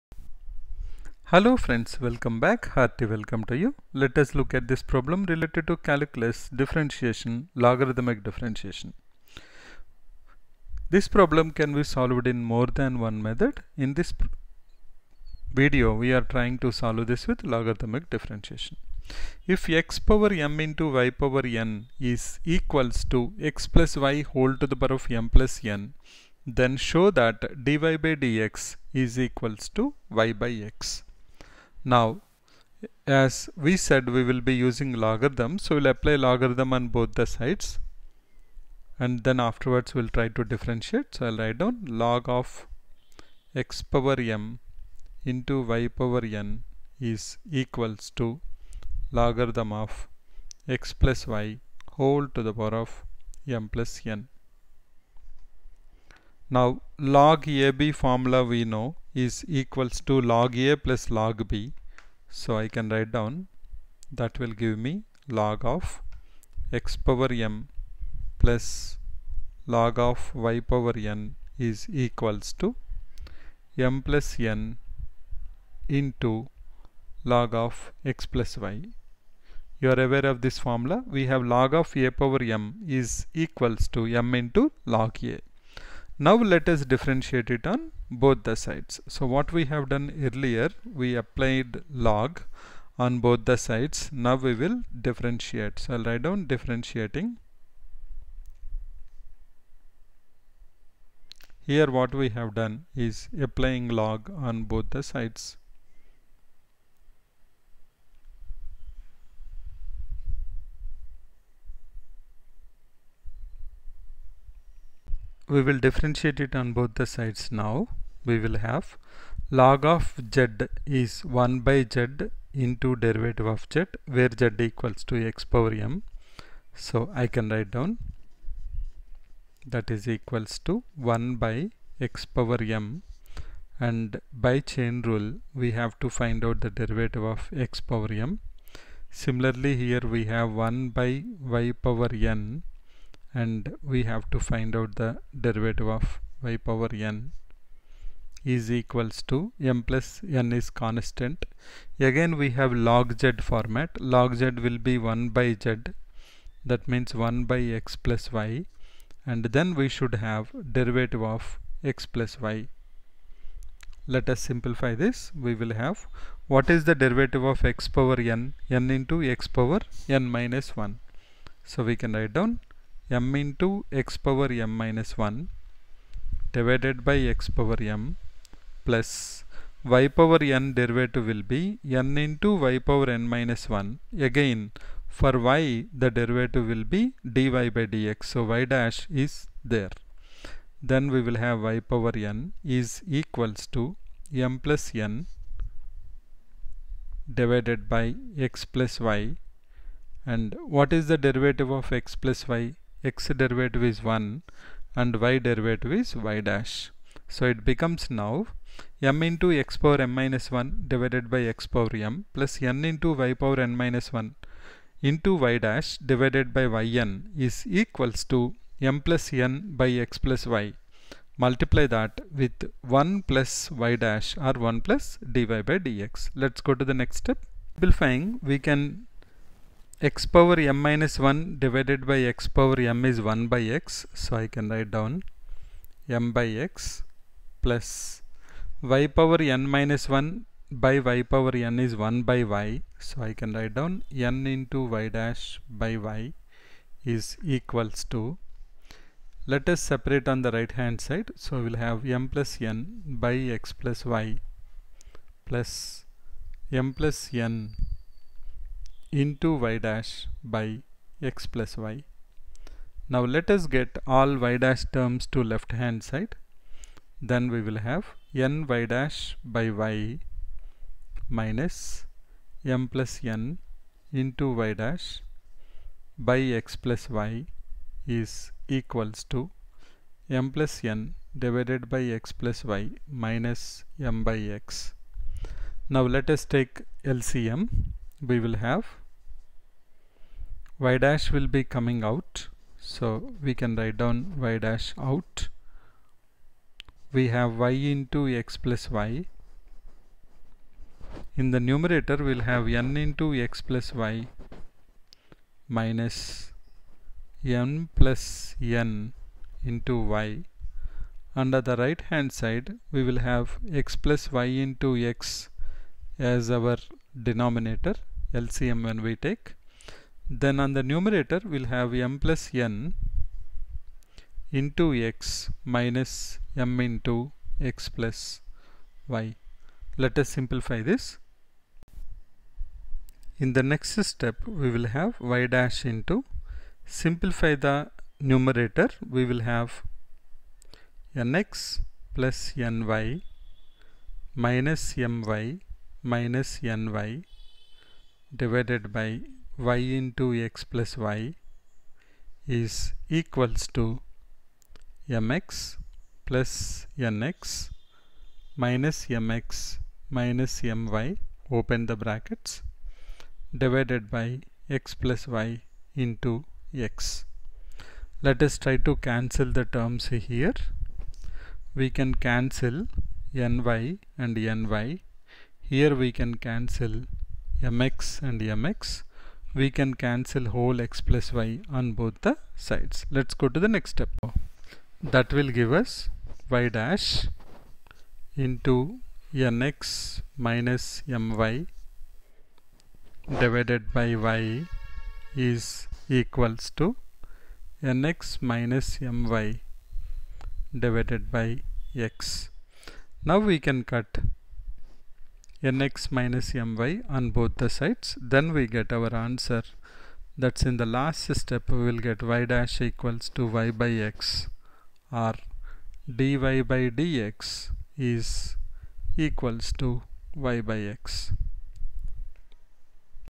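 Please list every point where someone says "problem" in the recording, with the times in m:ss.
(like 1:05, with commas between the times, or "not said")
0:04, 0:11.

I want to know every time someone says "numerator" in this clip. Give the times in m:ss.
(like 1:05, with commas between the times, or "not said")
5:01, 5:20, 5:38.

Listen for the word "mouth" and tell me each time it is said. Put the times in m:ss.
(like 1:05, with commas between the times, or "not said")
not said.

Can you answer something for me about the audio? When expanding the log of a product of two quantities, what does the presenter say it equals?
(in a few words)
log A plus log B.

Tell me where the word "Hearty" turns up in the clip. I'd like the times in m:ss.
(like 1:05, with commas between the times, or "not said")
0:02.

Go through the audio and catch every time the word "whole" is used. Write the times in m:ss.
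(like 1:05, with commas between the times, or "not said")
0:24, 0:51, 6:20.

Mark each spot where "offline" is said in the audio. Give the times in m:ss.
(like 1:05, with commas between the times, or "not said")
not said.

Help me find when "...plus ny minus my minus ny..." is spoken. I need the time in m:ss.
5:42.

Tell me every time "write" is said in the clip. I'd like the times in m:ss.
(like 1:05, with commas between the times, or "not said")
0:41, 1:02, 1:36, 2:07, 2:52, 3:54, 4:03, 4:53.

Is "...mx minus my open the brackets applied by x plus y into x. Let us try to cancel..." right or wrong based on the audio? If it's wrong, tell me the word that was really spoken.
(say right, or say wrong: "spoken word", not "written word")
wrong: "divided", not "applied".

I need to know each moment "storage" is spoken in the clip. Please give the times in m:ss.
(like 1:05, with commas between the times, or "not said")
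not said.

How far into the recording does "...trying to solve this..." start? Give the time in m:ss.
0:16.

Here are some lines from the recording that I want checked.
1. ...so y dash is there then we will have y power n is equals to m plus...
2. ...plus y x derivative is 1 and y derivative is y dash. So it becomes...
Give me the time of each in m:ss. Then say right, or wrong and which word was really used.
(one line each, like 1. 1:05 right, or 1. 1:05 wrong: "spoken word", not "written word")
1. 3:08 right
2. 3:22 right.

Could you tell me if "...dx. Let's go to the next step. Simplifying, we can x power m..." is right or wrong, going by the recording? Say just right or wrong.
right.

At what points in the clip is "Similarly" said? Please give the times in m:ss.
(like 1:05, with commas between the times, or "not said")
2:19.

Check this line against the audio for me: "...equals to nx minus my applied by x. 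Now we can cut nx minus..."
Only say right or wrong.
wrong.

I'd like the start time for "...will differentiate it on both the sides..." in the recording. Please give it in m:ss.
1:55.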